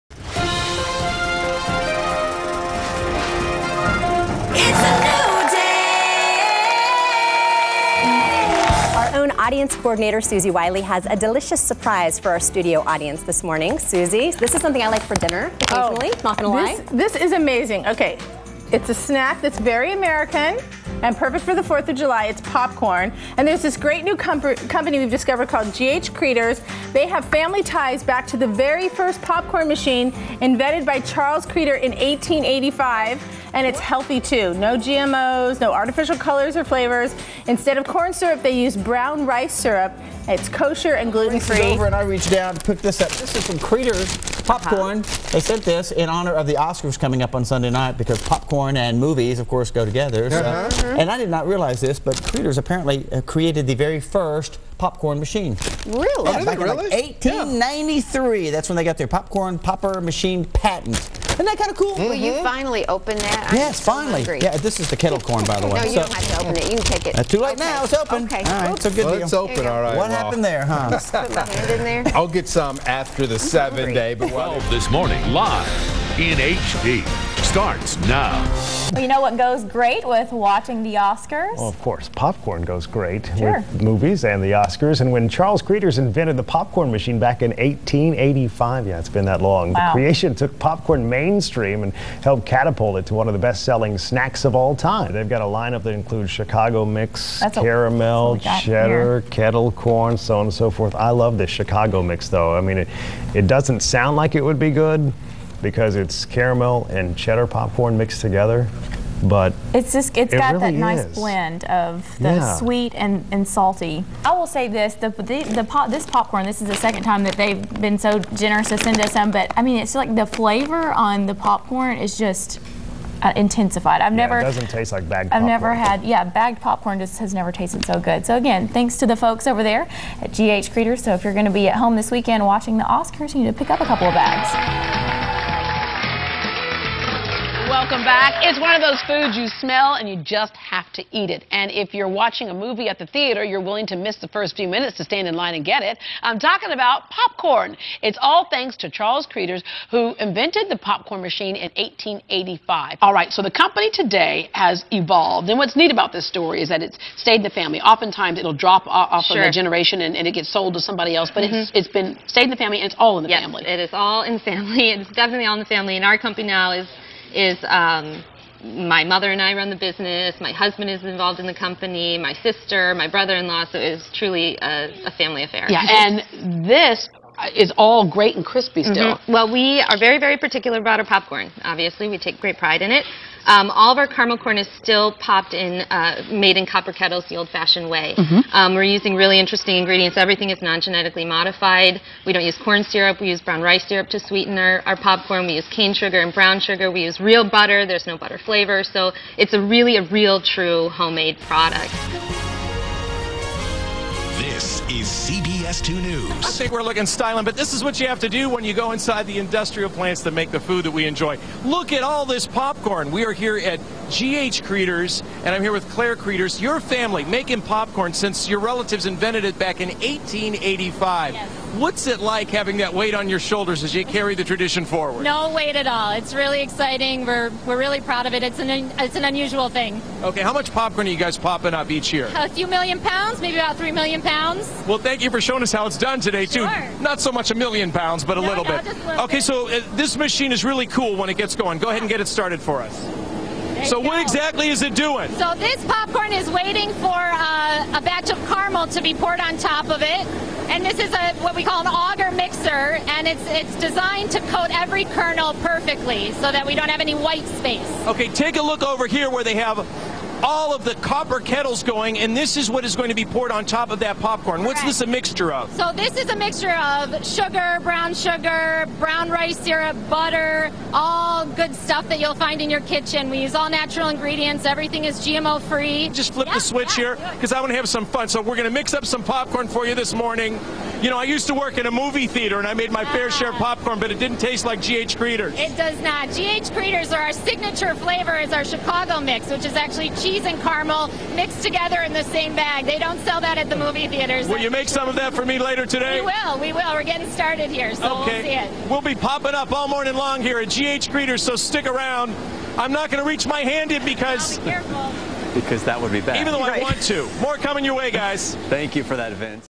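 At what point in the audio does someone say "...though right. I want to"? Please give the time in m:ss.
5:06.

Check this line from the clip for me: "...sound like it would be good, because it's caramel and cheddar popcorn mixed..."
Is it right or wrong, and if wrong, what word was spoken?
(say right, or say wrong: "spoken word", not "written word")
right.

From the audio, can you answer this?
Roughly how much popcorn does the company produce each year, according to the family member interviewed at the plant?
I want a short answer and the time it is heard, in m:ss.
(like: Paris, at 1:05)
3 million pounds, at 3:53.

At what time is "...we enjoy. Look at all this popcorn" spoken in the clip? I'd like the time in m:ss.
3:30.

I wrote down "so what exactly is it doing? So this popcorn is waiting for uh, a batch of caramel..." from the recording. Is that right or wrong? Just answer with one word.
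right.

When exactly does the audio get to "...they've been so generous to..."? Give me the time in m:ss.
1:57.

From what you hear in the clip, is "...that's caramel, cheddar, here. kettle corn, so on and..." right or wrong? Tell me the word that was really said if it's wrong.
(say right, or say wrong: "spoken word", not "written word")
right.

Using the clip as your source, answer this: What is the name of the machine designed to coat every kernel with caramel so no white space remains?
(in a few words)
auger mixer.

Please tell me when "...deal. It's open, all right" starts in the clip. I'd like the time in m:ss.
1:09.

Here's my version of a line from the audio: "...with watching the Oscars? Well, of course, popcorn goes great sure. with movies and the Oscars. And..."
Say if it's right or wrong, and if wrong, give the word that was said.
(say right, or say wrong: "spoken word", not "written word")
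right.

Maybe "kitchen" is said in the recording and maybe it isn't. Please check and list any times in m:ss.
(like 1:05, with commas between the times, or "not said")
4:32.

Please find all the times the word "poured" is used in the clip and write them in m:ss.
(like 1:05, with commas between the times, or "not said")
4:09, 4:23.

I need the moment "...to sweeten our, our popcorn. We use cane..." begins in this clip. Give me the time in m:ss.
3:14.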